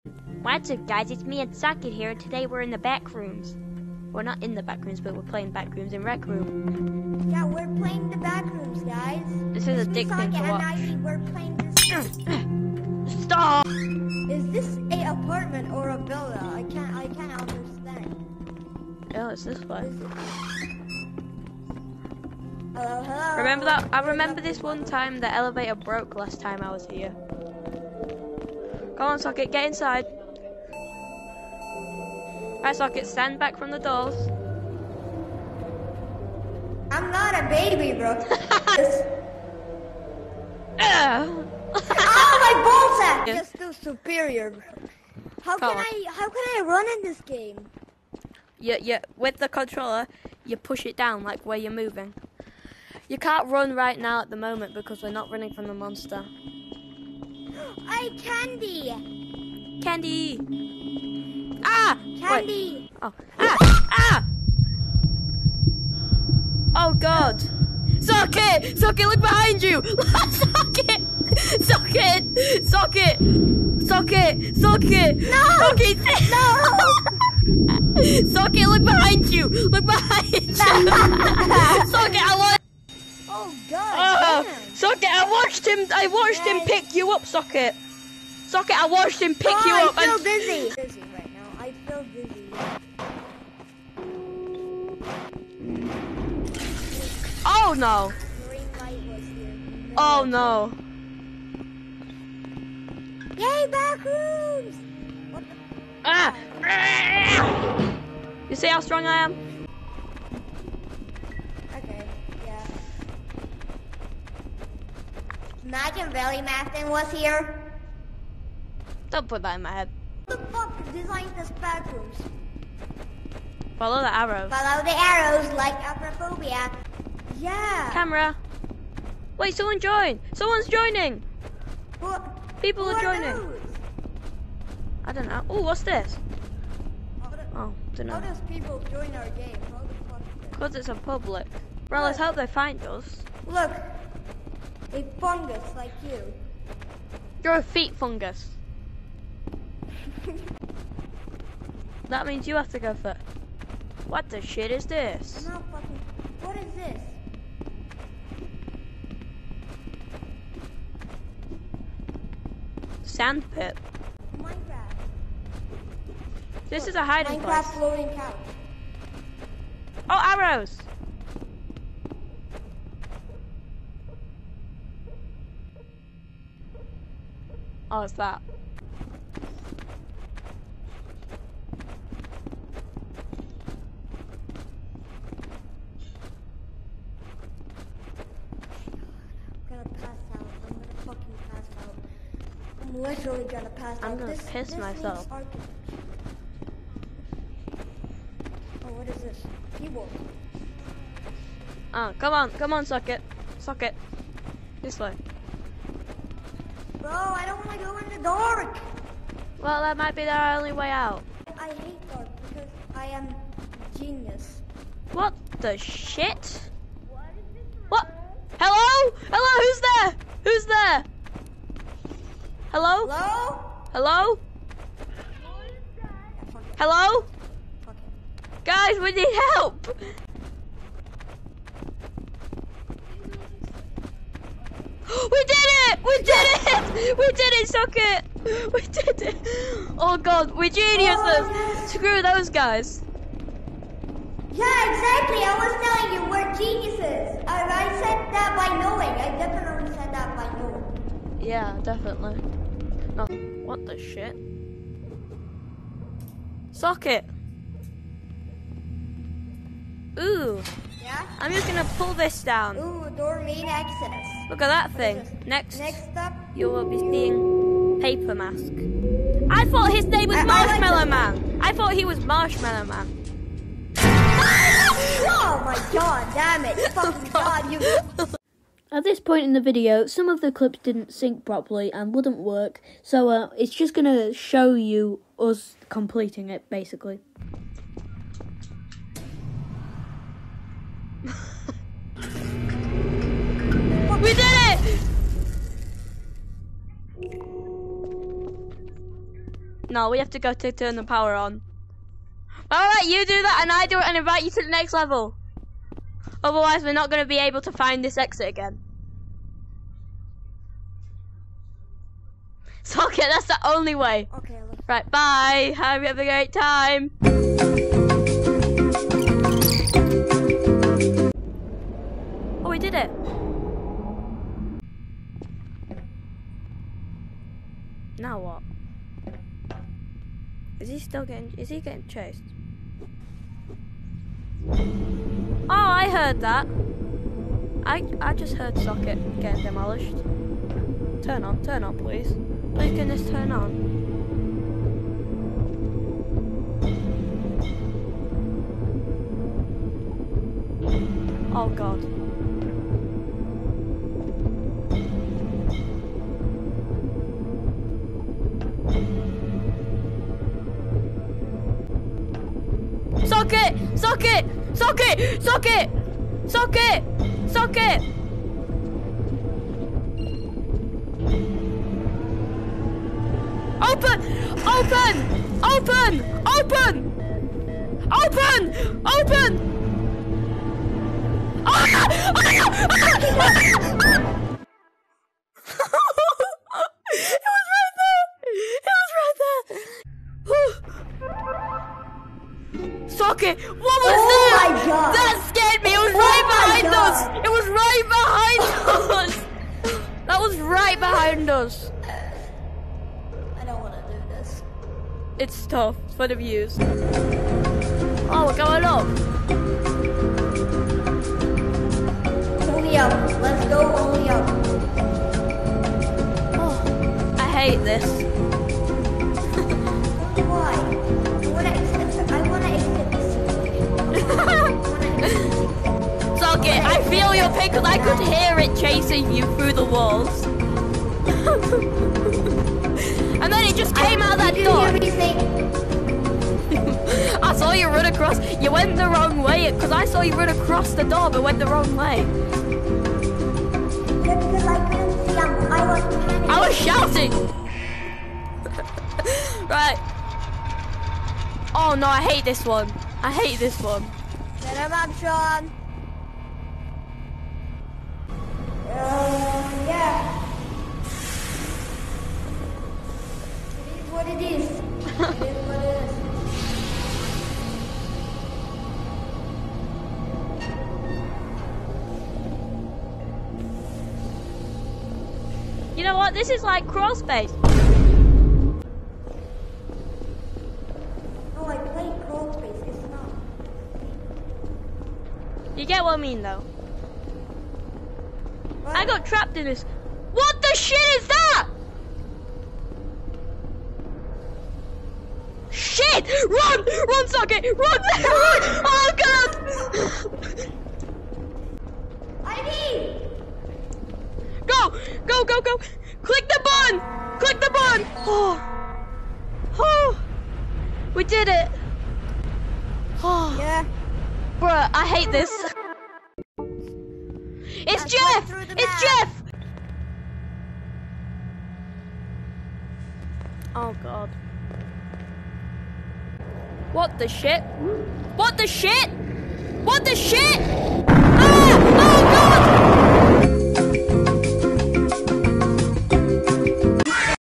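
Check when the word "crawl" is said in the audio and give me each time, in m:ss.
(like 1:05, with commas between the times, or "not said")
7:56, 8:02.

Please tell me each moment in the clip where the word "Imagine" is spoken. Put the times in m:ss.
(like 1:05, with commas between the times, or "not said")
1:55.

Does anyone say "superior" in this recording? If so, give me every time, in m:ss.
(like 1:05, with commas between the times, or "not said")
0:43.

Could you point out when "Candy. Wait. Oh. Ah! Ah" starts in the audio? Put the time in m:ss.
1:02.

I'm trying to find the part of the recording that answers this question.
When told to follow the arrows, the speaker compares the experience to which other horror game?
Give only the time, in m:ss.
2:05.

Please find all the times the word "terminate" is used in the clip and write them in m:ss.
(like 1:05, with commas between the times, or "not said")
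not said.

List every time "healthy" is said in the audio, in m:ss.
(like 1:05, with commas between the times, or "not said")
not said.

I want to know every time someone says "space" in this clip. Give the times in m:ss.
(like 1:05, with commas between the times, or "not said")
7:57, 8:02.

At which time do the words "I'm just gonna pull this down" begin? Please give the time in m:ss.
4:21.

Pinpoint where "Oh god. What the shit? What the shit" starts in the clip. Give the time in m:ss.
8:43.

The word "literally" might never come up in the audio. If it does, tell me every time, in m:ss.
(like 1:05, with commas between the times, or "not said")
3:13.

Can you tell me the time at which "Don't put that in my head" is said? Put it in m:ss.
1:59.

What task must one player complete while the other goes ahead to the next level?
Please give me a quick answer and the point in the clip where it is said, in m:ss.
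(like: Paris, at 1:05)
turn the power on, at 5:00.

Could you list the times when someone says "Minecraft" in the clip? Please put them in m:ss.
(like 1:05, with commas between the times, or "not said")
2:43, 2:47.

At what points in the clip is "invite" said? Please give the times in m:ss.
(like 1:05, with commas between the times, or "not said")
5:04.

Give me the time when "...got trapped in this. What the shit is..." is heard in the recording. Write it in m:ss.
8:09.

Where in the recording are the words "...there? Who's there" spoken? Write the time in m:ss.
3:40.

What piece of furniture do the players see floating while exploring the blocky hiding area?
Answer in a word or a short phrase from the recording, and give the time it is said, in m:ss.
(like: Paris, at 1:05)
couch, at 2:47.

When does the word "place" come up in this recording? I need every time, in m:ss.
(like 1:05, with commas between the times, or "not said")
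2:47.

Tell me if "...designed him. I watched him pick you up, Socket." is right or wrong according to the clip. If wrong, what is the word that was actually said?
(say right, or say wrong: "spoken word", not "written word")
wrong: "watched", not "designed".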